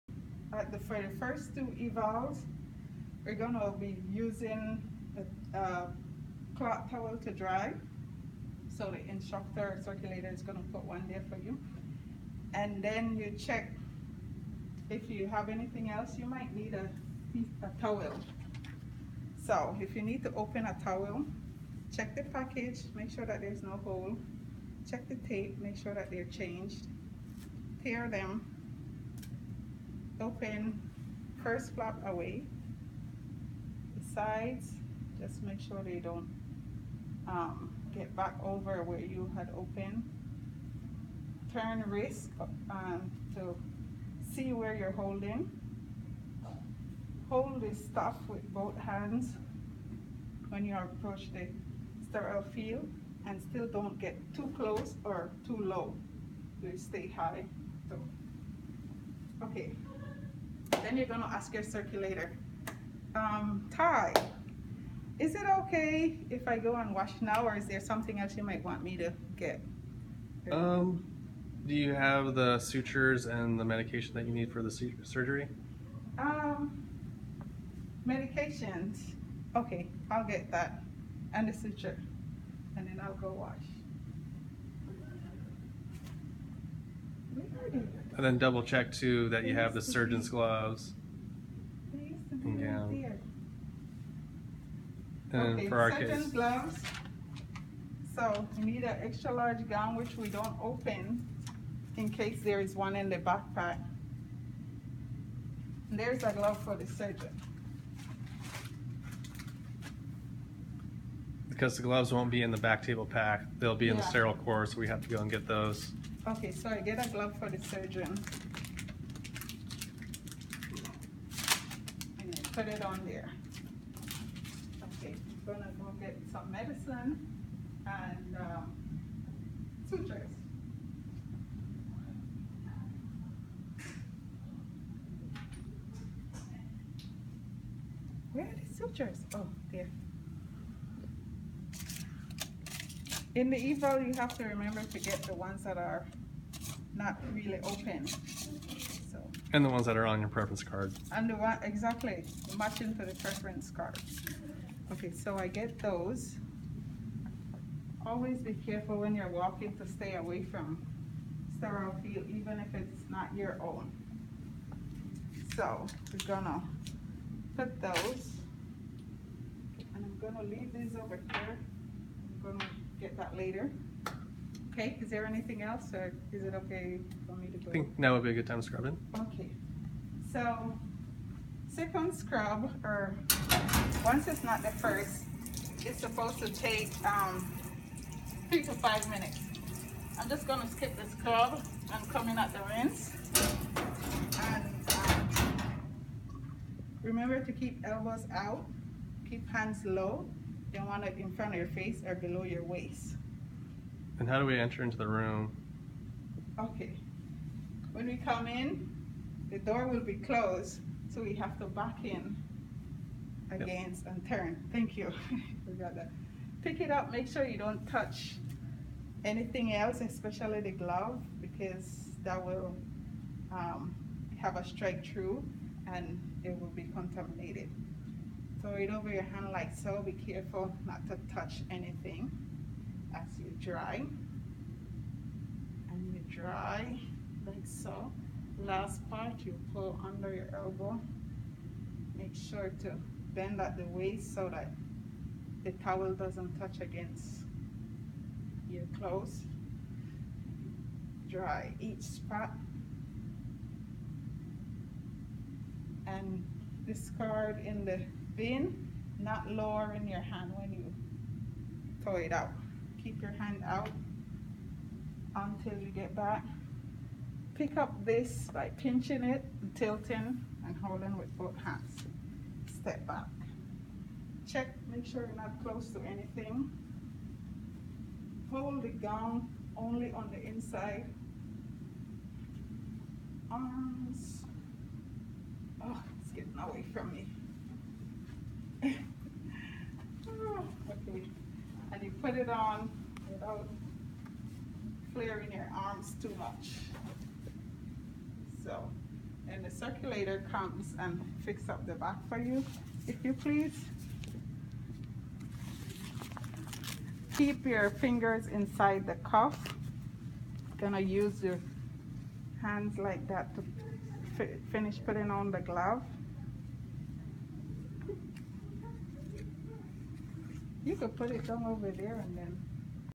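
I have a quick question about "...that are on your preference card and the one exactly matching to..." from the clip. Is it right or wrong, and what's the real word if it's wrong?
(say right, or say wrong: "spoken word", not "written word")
right.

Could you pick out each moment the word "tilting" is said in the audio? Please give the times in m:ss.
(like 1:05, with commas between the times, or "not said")
4:29.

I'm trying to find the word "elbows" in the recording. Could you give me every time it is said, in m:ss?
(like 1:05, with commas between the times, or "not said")
3:17, 4:00.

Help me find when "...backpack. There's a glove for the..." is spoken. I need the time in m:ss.
1:43.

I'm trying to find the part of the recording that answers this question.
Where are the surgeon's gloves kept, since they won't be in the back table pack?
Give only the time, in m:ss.
1:54.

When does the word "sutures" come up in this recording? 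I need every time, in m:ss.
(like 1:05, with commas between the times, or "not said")
1:12, 1:21, 2:09, 2:18.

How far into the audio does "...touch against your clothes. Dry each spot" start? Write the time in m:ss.
4:06.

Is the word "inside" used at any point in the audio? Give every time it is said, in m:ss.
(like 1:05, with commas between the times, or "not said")
4:40, 5:08.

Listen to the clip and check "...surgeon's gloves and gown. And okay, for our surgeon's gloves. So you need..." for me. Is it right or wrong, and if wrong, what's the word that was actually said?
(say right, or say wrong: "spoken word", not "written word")
right.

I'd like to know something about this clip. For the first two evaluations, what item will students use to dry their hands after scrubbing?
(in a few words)
cloth towel.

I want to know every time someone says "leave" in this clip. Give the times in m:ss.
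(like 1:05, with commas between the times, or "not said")
2:50.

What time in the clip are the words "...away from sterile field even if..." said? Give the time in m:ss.
2:40.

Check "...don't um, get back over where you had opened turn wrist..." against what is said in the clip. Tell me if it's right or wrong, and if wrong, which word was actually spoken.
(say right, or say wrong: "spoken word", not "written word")
right.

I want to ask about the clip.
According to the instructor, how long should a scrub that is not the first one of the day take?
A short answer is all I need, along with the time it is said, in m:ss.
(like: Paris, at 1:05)
3 to 5 minutes, at 3:08.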